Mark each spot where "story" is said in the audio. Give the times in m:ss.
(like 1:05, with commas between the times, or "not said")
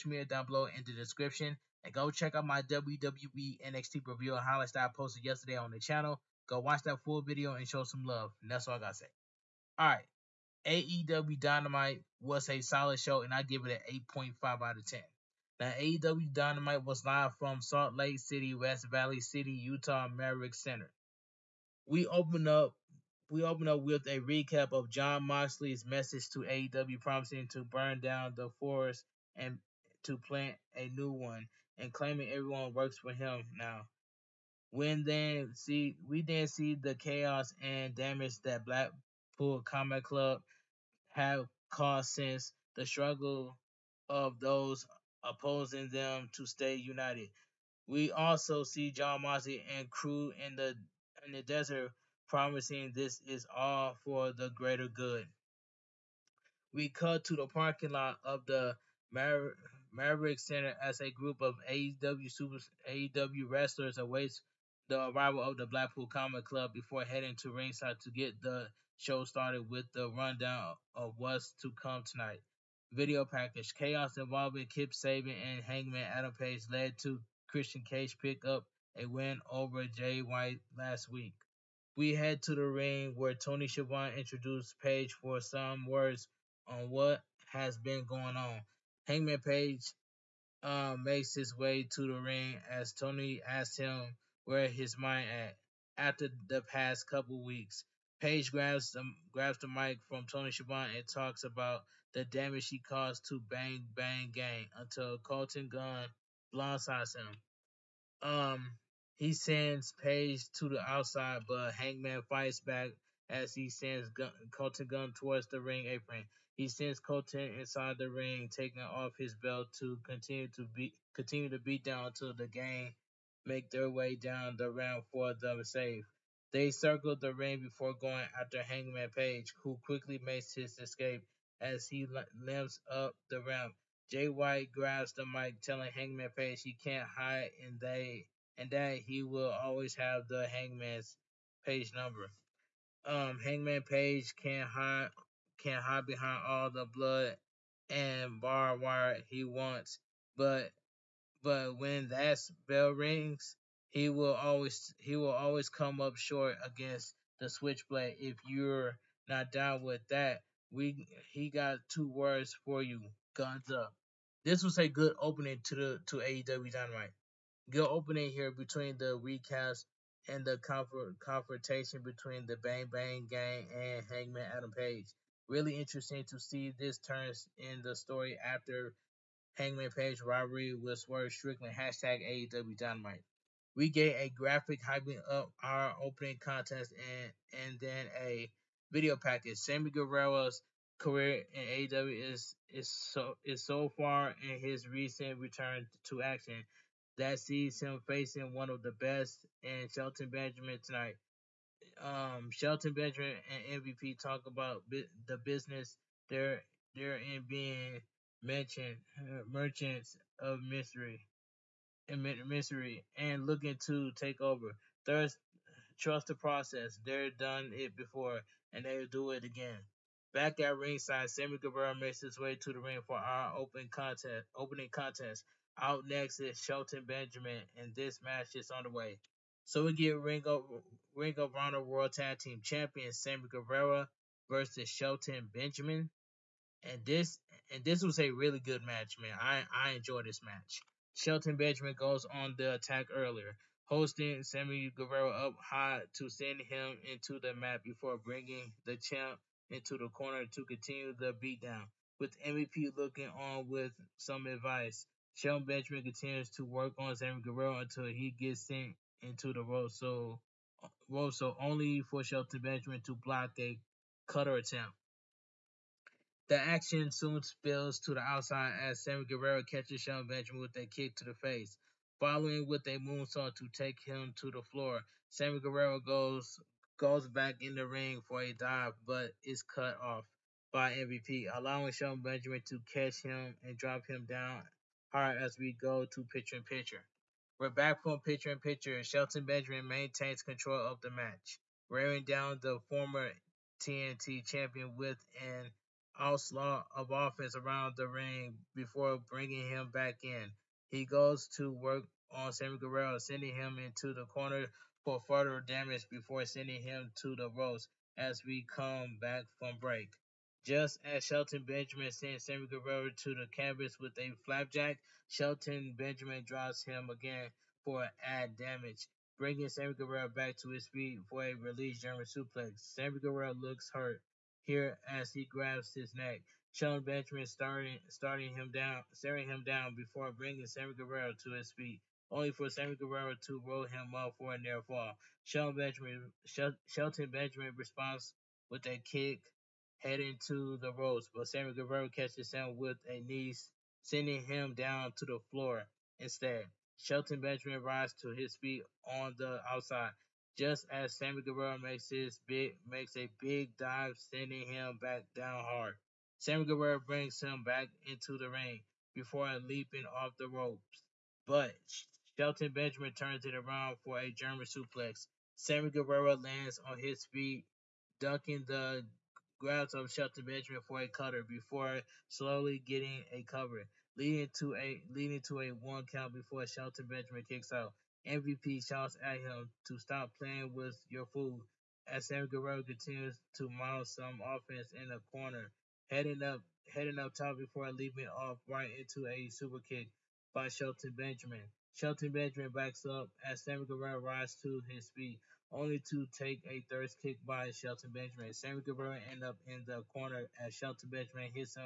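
2:57.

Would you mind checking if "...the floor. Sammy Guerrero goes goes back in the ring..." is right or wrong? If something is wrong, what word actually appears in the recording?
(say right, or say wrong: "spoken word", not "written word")
right.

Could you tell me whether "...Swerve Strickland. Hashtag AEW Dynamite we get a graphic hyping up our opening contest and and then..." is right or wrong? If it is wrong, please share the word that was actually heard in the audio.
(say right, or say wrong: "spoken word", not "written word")
right.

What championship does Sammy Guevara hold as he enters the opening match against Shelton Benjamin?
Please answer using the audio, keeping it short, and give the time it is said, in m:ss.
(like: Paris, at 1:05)
Ring of Honor World Tag Team, at 3:51.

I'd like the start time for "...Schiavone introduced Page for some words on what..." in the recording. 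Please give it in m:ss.
1:23.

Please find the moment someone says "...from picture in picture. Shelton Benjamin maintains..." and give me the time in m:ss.
4:48.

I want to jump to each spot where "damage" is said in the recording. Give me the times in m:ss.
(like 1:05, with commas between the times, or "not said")
0:37, 1:42, 5:05, 5:18.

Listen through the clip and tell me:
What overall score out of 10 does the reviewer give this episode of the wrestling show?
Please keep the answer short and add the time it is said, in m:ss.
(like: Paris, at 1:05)
8.5, at 0:14.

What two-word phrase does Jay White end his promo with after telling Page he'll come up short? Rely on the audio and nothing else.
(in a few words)
Guns up.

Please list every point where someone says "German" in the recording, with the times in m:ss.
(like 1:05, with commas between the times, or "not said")
5:21, 6:04.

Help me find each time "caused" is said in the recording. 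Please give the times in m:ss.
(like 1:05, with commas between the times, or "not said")
0:41, 1:42.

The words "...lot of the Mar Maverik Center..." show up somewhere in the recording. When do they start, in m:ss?
0:57.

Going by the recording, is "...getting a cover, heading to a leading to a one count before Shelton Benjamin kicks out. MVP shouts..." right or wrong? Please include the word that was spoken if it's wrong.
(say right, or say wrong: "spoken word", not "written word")
wrong: "leading", not "heading".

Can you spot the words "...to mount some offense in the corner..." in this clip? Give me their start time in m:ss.
6:23.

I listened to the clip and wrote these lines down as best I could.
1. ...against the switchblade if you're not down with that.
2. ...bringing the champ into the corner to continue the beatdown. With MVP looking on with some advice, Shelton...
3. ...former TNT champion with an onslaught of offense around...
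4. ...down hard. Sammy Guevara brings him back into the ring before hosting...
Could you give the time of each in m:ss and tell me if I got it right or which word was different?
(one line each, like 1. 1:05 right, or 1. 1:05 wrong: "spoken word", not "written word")
1. 2:36 right
2. 4:08 right
3. 4:52 right
4. 5:55 wrong: "leaping", not "hosting".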